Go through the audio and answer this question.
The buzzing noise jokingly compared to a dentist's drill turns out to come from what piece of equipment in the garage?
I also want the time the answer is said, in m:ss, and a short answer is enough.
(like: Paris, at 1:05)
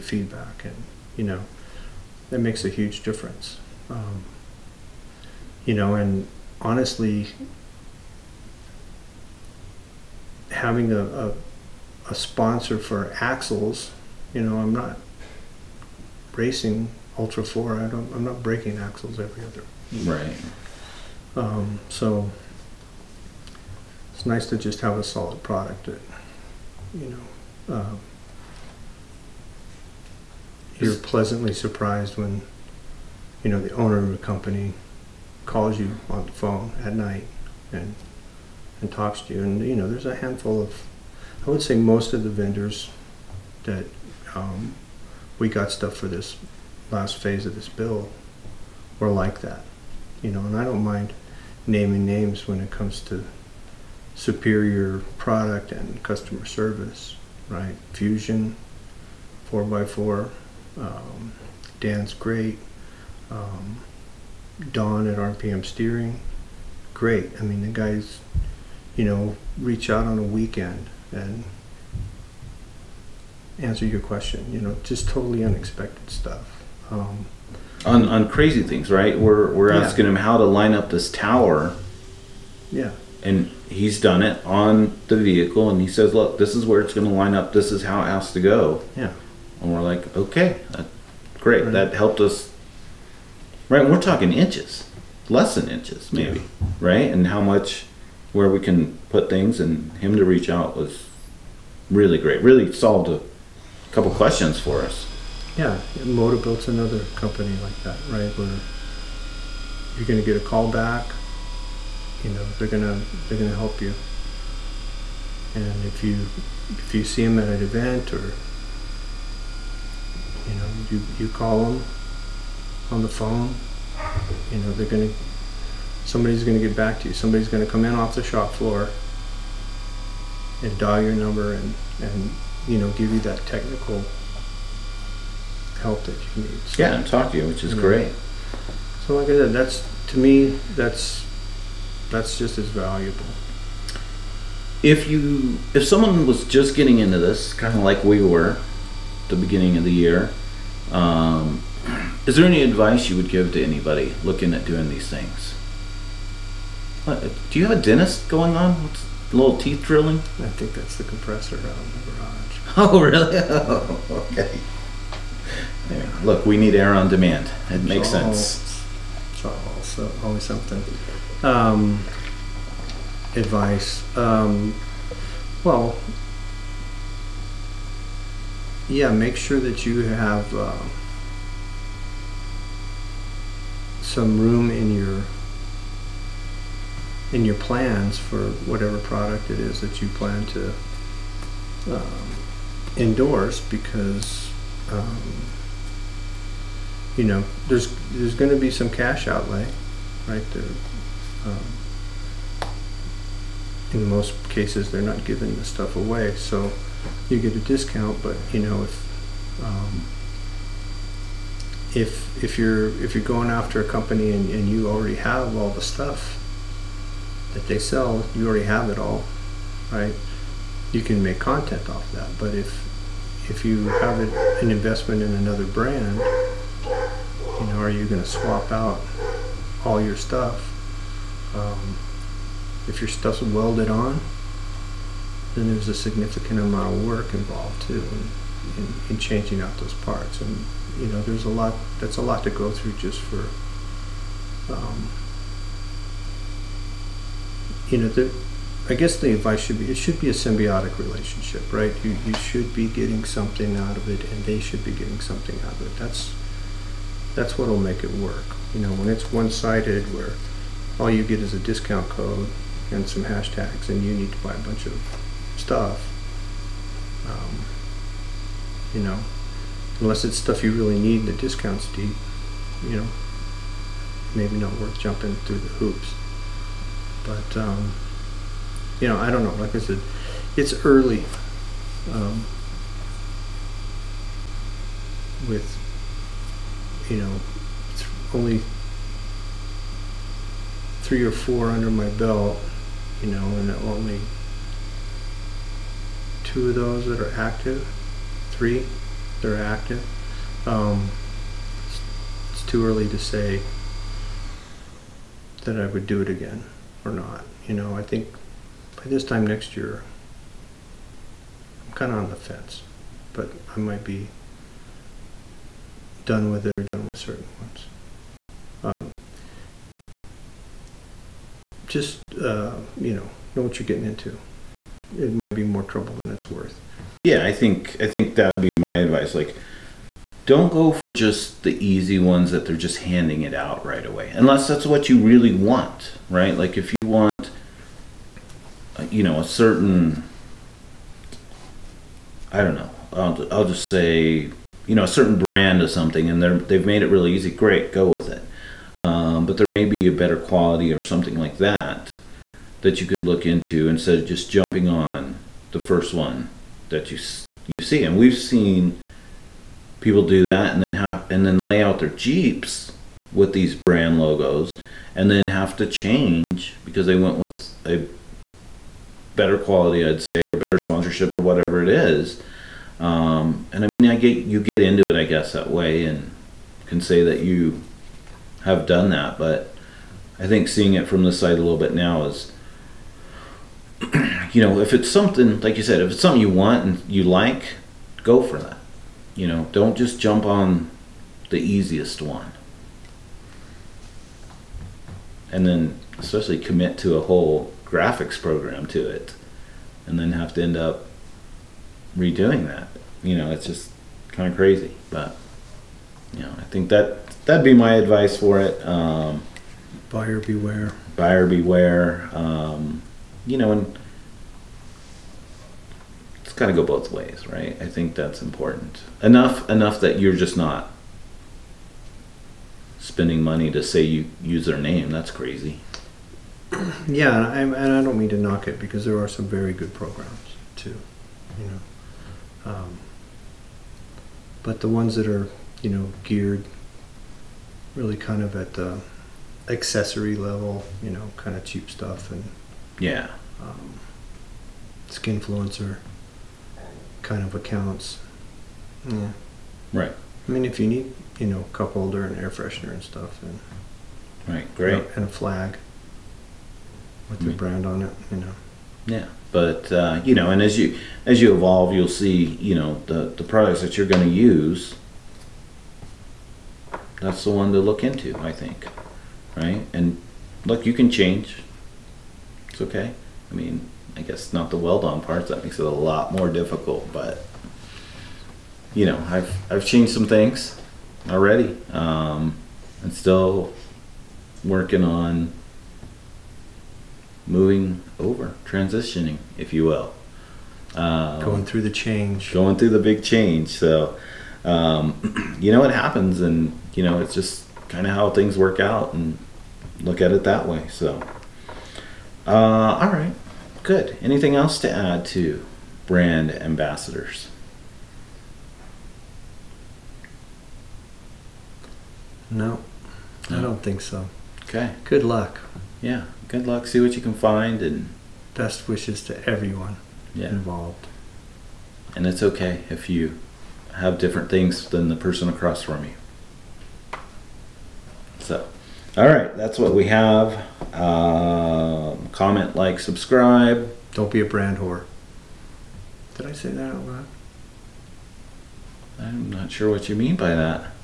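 The compressor, at 2:41.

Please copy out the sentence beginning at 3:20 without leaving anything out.
There um, in most cases, they're not giving the stuff away, so you get a discount.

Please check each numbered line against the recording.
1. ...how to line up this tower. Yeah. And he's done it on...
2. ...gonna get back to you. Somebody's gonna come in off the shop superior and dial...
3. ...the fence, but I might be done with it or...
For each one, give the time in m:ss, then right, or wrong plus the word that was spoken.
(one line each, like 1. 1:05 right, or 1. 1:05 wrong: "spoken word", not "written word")
1. 1:20 right
2. 2:06 wrong: "floor", not "superior"
3. 5:12 right.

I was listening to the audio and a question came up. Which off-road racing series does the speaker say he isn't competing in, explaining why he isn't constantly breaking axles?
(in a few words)
Ultra Four.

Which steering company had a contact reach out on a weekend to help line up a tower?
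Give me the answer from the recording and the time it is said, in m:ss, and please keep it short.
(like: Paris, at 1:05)
RPM Steering, at 1:05.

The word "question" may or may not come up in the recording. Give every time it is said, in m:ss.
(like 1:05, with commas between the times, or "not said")
1:13, 1:44.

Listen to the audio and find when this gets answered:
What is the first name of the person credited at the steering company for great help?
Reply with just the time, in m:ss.
1:04.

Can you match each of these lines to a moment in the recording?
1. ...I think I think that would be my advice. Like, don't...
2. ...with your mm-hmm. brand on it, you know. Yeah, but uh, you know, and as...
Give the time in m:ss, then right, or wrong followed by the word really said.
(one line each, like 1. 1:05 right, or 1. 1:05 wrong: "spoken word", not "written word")
1. 5:27 right
2. 7:37 right.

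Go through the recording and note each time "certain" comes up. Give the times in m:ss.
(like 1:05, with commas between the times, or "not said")
5:17, 5:39, 5:45.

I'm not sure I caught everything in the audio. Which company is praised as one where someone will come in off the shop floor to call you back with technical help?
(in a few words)
Motobilt.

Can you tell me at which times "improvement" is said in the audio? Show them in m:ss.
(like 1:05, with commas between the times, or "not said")
not said.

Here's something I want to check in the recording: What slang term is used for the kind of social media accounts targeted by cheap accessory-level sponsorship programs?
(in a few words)
skinfluencer.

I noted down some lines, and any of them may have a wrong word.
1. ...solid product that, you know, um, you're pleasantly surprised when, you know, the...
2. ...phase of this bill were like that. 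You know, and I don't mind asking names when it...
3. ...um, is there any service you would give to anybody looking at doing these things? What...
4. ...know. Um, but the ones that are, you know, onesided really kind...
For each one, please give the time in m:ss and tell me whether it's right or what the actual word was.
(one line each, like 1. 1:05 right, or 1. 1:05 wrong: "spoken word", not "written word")
1. 0:25 right
2. 0:47 wrong: "naming", not "asking"
3. 2:30 wrong: "advice", not "service"
4. 7:11 wrong: "geared", not "onesided".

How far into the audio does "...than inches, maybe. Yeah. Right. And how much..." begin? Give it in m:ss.
1:35.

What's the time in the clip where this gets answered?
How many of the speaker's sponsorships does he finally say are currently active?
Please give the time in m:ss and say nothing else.
4:58.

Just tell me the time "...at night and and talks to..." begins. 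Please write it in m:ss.
0:36.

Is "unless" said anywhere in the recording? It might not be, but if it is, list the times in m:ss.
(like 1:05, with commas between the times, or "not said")
4:29, 5:34.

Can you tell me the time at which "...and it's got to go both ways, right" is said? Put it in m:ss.
6:53.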